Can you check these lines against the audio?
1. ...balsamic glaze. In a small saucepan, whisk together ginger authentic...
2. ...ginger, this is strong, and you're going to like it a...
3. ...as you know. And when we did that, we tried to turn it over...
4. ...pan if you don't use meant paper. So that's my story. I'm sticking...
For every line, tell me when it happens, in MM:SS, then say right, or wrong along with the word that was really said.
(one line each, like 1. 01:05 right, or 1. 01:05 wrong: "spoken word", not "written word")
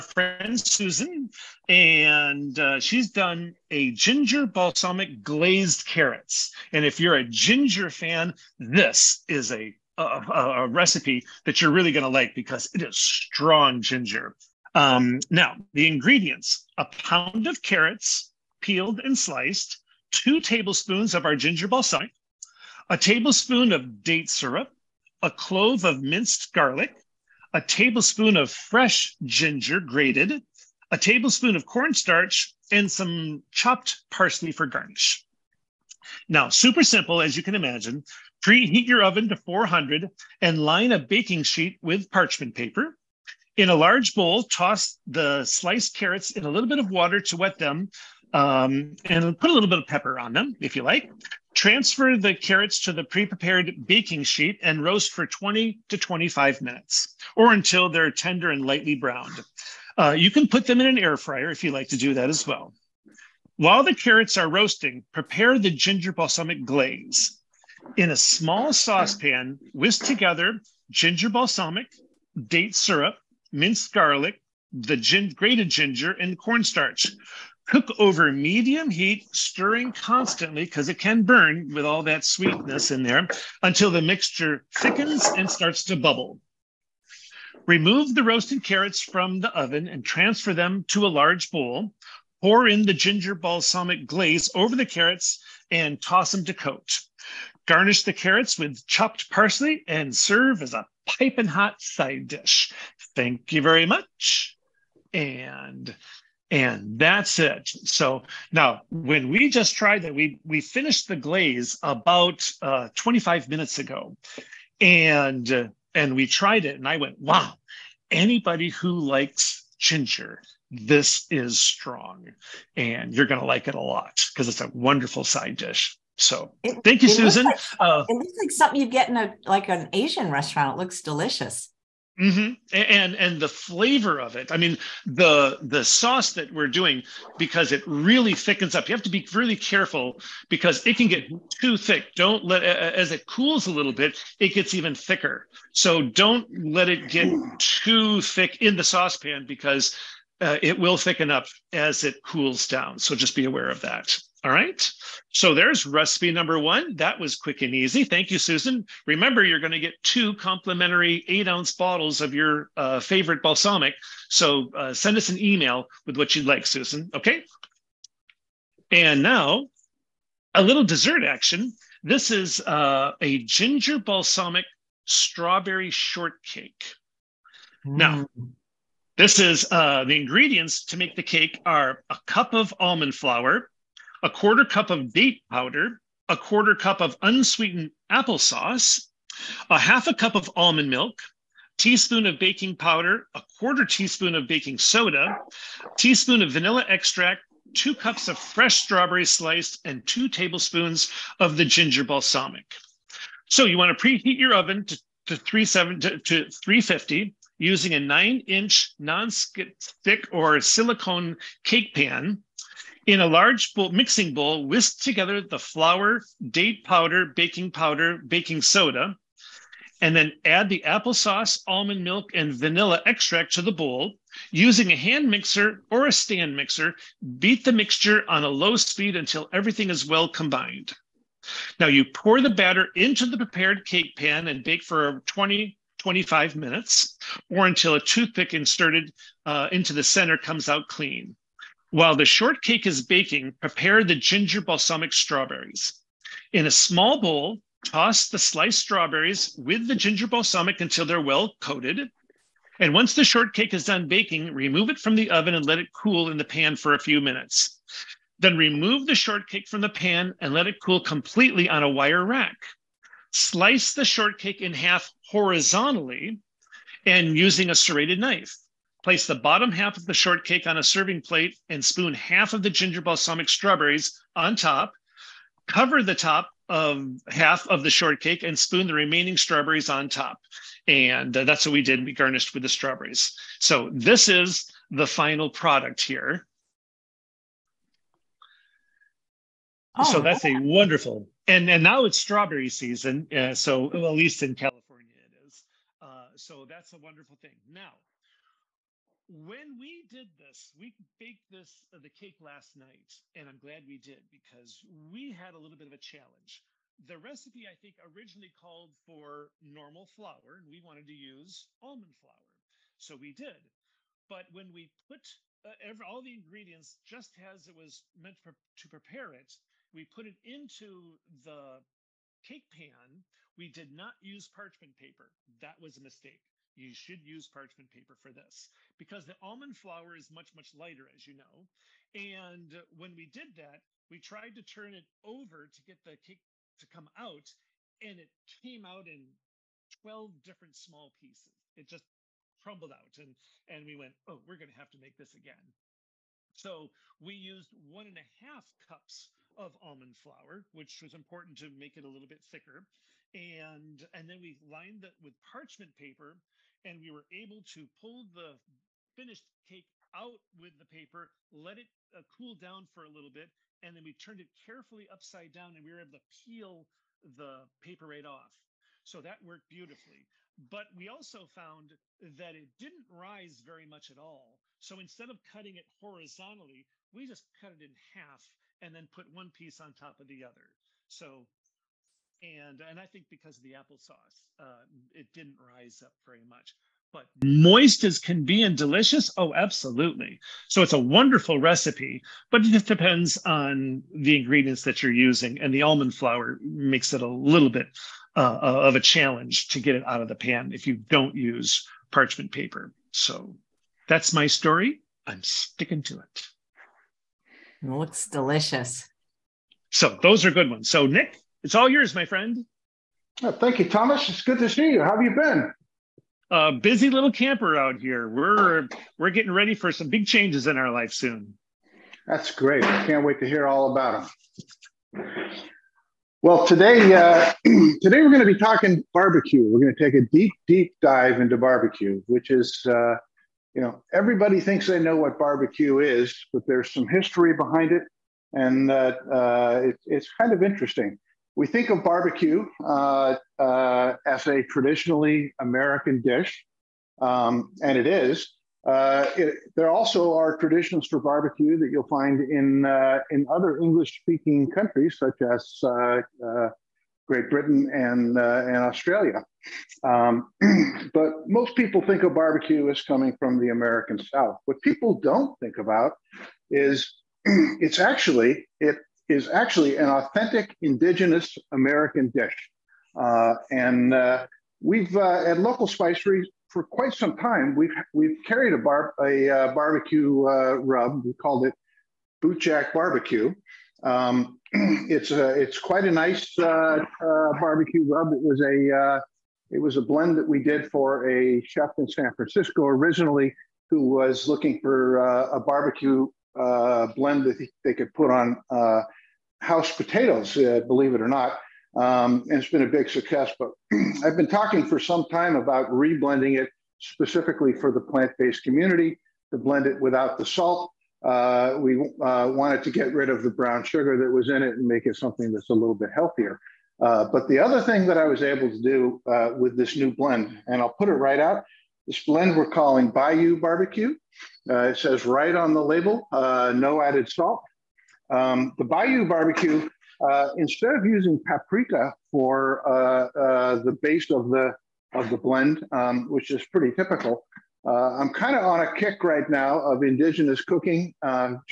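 1. 01:06 wrong: "balsamic", not "authentic"
2. 01:59 right
3. 05:31 right
4. 06:40 wrong: "parchment", not "meant".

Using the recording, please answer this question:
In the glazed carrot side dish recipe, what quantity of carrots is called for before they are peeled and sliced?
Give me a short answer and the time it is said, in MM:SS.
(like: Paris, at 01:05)
1 pound, at 00:16.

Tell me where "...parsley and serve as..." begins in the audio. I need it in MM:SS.
01:39.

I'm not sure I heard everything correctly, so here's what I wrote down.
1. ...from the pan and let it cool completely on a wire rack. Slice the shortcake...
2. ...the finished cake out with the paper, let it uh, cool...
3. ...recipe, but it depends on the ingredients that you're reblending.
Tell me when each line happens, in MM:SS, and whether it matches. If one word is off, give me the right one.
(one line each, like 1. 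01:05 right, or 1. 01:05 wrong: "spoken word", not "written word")
1. 04:19 right
2. 05:58 right
3. 06:31 wrong: "using", not "reblending".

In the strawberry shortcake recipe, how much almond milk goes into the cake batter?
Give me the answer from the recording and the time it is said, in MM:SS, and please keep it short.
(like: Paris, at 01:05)
half a cup, at 03:09.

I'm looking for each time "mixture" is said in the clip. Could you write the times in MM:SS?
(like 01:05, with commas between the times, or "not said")
01:24, 03:47.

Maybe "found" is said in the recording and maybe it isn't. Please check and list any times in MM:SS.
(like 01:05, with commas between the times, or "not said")
06:11.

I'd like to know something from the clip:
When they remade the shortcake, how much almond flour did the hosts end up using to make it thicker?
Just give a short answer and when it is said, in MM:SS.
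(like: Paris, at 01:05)
1.5 cups, at 05:47.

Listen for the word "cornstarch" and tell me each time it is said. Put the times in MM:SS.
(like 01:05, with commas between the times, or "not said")
00:31, 01:16.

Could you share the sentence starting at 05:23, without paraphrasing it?
We did not use parchment paper.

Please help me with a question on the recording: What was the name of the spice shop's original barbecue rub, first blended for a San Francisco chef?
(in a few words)
Bootjack Barbecue.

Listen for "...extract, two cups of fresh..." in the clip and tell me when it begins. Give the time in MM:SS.
03:16.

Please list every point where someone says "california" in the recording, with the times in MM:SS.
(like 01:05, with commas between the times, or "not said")
04:54.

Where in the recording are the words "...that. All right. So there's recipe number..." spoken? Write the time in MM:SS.
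02:33.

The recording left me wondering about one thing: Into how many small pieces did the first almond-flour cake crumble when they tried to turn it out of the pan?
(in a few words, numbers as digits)
12.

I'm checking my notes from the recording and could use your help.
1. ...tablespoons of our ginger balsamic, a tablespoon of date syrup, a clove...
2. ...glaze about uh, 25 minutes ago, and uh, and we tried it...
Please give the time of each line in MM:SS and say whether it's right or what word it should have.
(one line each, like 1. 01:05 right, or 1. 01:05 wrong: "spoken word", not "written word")
1. 00:20 right
2. 01:51 right.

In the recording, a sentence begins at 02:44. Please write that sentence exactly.
So uh, send us an email with what you'd like, Susan.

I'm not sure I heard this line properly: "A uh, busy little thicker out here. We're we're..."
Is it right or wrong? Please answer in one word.
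wrong.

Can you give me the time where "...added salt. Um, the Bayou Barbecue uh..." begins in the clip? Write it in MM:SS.
08:47.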